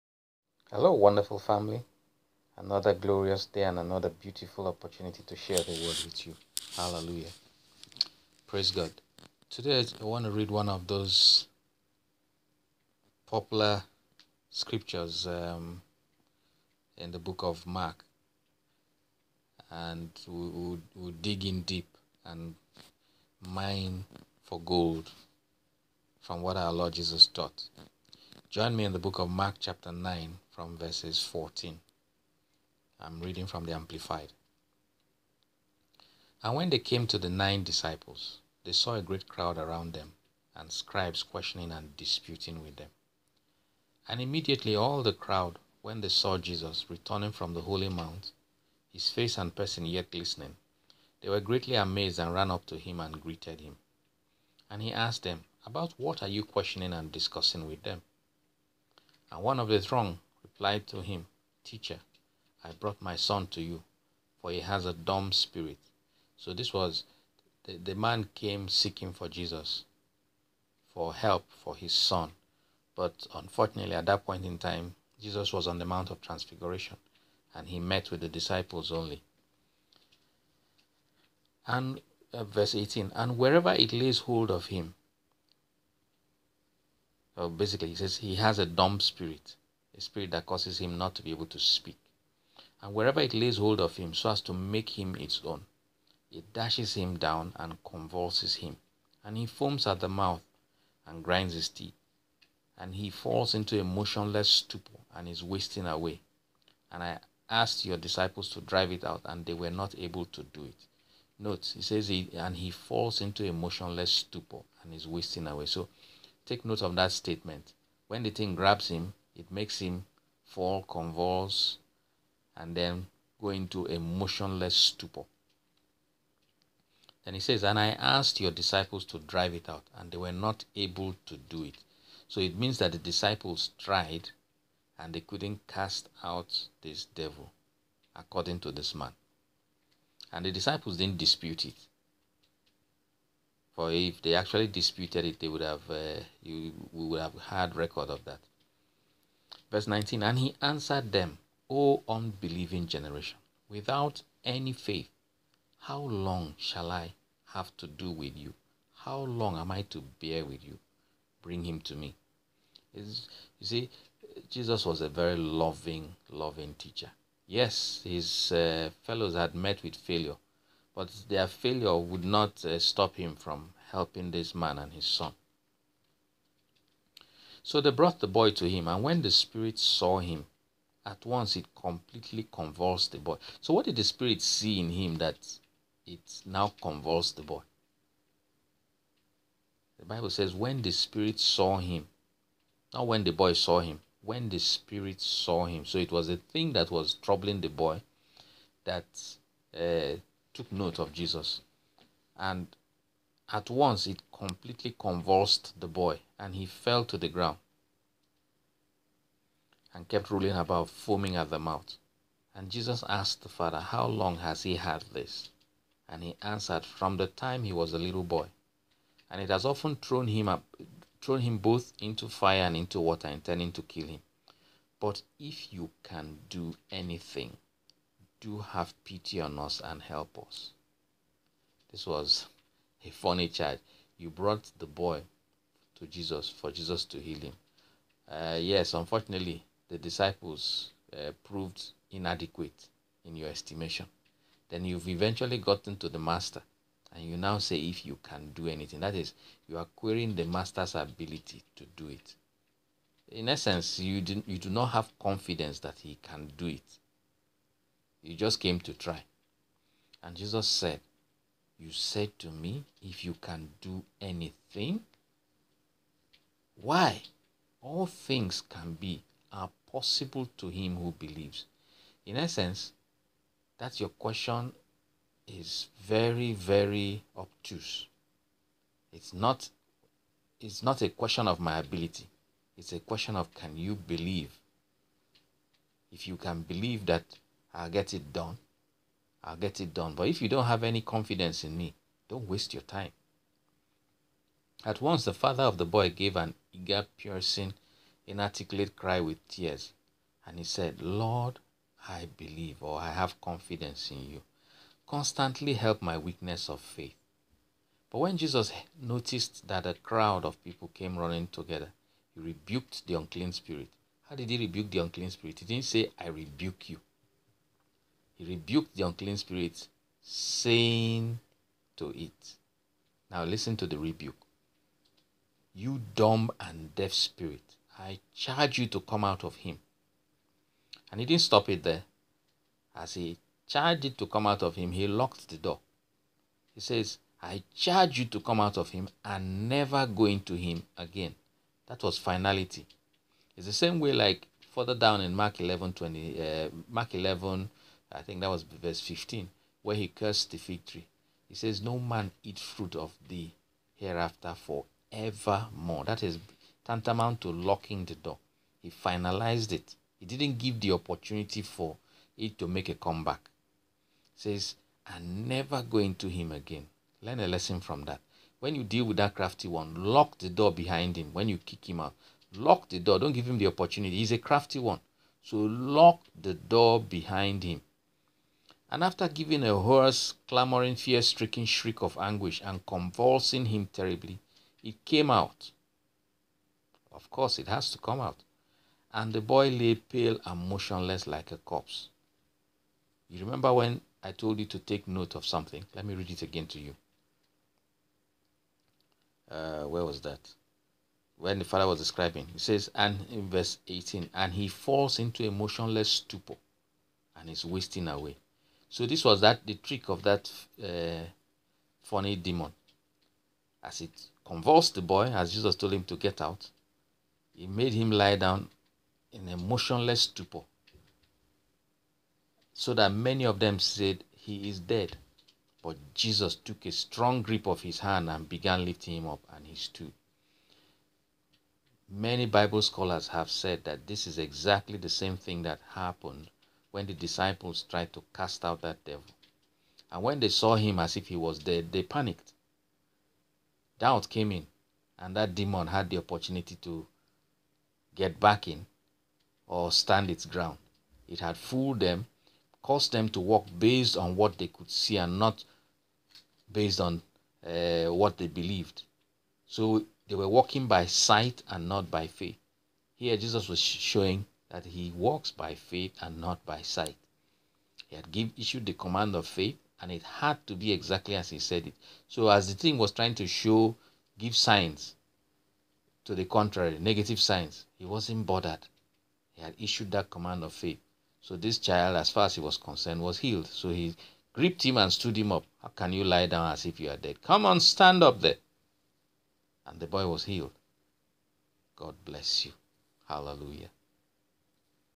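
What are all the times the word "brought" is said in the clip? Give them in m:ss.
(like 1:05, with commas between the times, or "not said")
1:02, 2:57, 3:54.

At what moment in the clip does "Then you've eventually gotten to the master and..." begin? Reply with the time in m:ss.
4:04.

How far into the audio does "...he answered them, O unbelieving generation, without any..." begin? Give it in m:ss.
2:30.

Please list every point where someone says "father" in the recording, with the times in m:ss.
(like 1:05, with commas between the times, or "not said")
3:33, 4:55, 6:41.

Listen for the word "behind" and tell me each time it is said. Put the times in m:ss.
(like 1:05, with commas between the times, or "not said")
6:10, 6:17.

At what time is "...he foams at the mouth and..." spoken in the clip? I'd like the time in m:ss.
1:39.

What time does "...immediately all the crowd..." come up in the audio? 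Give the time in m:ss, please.
0:44.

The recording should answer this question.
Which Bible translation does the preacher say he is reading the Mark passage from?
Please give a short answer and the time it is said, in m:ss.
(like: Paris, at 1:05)
Amplified, at 0:33.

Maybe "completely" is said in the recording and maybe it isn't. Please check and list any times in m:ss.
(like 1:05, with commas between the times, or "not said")
3:01, 3:24.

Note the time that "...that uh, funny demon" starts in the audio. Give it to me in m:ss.
6:50.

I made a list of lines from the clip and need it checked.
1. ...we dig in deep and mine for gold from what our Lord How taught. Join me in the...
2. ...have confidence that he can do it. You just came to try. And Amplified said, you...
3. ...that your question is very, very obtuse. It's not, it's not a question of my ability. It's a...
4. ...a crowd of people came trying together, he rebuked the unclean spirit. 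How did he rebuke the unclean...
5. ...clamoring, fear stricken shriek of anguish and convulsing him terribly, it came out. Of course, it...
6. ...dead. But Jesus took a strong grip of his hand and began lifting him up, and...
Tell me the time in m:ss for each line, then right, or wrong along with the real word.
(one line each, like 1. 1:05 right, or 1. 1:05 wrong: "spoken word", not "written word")
1. 0:20 wrong: "Jesus", not "How"
2. 4:14 wrong: "Jesus", not "Amplified"
3. 4:33 right
4. 5:09 wrong: "running", not "trying"
5. 6:20 right
6. 7:04 right.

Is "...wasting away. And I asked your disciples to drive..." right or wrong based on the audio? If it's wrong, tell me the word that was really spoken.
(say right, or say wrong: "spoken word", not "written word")
right.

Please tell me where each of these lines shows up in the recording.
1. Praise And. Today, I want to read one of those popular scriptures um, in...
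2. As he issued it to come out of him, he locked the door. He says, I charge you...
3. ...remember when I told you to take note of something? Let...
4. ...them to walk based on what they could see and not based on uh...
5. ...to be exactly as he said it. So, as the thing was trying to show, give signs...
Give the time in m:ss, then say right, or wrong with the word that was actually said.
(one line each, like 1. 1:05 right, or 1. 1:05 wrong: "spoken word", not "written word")
1. 0:08 wrong: "God", not "And"
2. 5:32 wrong: "charged", not "issued"
3. 6:33 right
4. 7:33 right
5. 7:50 right.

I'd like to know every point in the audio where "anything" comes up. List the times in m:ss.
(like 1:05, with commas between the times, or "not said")
3:46, 4:08, 4:24.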